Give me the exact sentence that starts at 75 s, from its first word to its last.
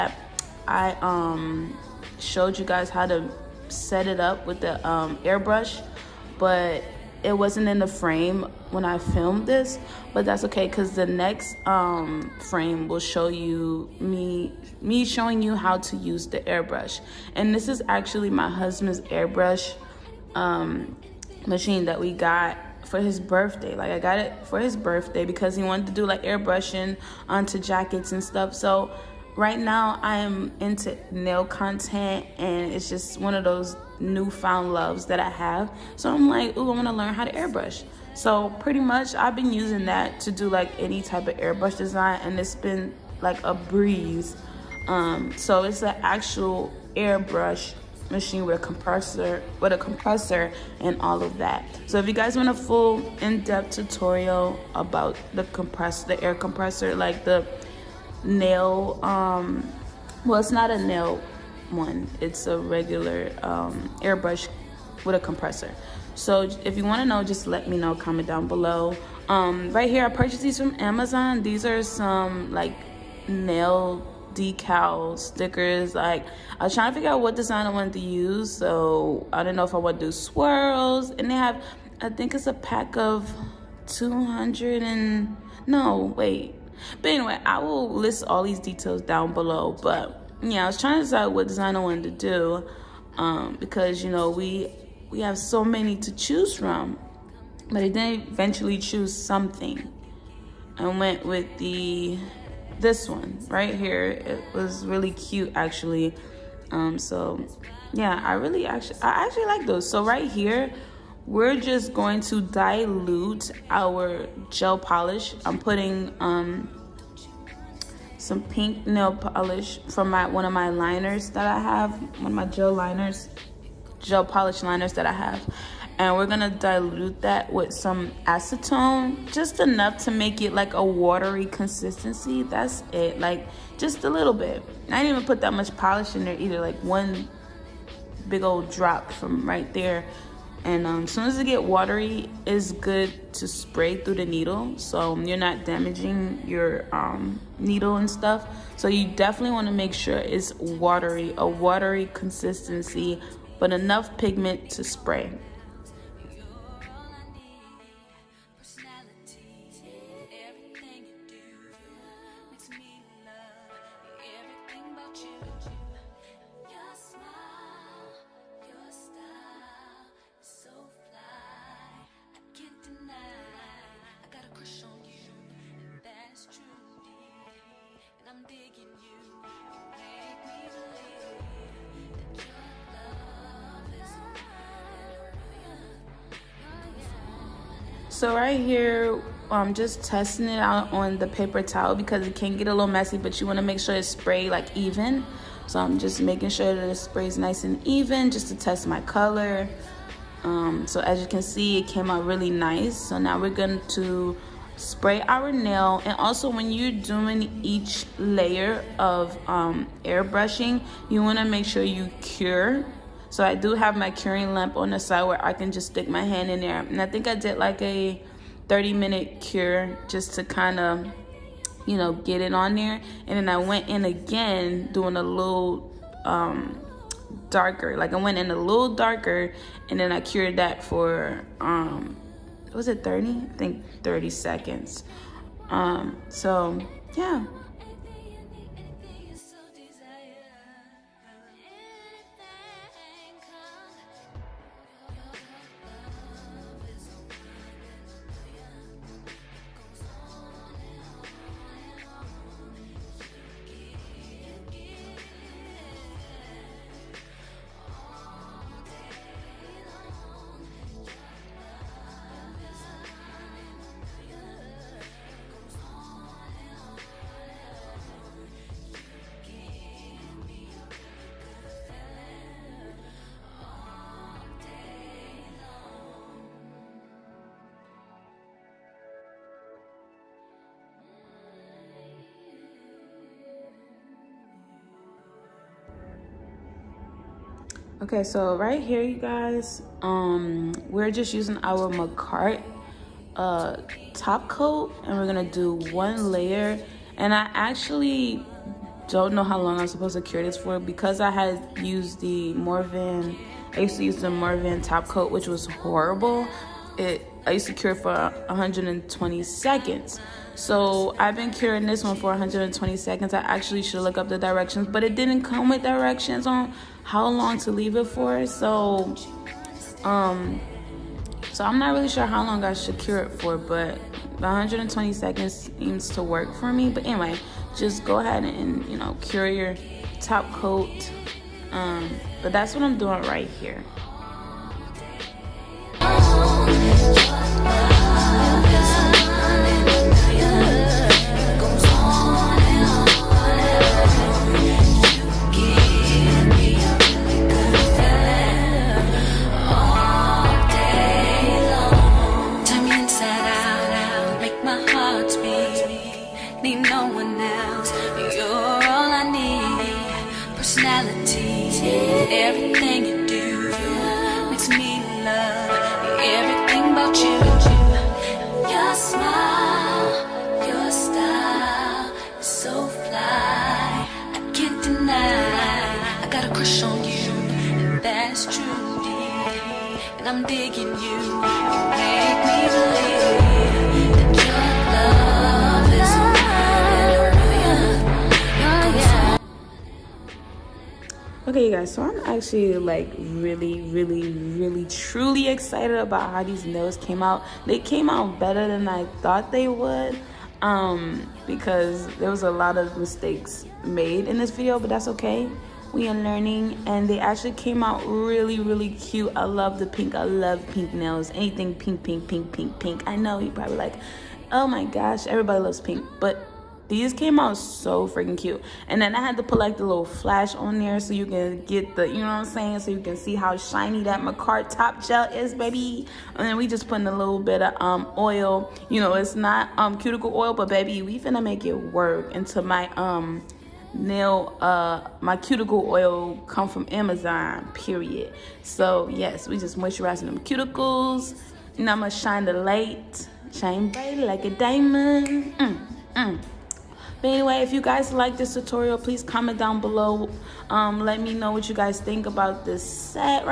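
Like I was trying to figure out what design I wanted to use.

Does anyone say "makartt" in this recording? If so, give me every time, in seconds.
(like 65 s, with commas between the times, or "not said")
291 s, 424 s.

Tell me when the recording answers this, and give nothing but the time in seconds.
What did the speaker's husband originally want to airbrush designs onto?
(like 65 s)
27 s.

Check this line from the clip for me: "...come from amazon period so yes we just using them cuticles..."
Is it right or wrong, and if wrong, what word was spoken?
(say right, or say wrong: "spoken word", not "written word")
wrong: "moisturizing", not "using".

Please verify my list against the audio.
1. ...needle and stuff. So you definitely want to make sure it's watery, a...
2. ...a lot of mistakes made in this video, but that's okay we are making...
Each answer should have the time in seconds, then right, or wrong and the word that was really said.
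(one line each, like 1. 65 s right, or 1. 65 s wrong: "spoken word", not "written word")
1. 147 s right
2. 402 s wrong: "learning", not "making".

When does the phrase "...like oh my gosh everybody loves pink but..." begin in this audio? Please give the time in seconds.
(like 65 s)
413 s.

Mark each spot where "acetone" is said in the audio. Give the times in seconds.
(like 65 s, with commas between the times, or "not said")
128 s.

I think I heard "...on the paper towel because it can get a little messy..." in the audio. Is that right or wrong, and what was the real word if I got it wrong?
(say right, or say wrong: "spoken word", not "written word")
right.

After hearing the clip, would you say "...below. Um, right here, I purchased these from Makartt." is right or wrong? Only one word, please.
wrong.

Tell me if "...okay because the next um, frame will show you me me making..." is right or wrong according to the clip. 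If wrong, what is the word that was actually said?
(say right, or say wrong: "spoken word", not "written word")
wrong: "showing", not "making".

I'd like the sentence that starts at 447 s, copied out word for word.
But anyway, if you guys like this tutorial, please comment down below.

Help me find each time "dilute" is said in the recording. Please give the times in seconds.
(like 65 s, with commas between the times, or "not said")
112 s, 126 s.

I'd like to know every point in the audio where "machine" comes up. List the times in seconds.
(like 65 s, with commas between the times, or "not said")
21 s, 48 s.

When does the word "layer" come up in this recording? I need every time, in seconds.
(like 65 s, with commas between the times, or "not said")
208 s, 296 s.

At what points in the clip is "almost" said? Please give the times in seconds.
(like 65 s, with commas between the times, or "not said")
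not said.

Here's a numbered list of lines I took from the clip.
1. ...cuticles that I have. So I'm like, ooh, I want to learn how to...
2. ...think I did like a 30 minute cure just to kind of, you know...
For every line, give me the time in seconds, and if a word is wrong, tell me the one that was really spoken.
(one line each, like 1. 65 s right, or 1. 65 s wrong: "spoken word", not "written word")
1. 34 s wrong: "loves", not "cuticles"
2. 217 s right.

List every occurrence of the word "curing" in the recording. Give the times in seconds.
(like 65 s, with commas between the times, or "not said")
214 s, 311 s.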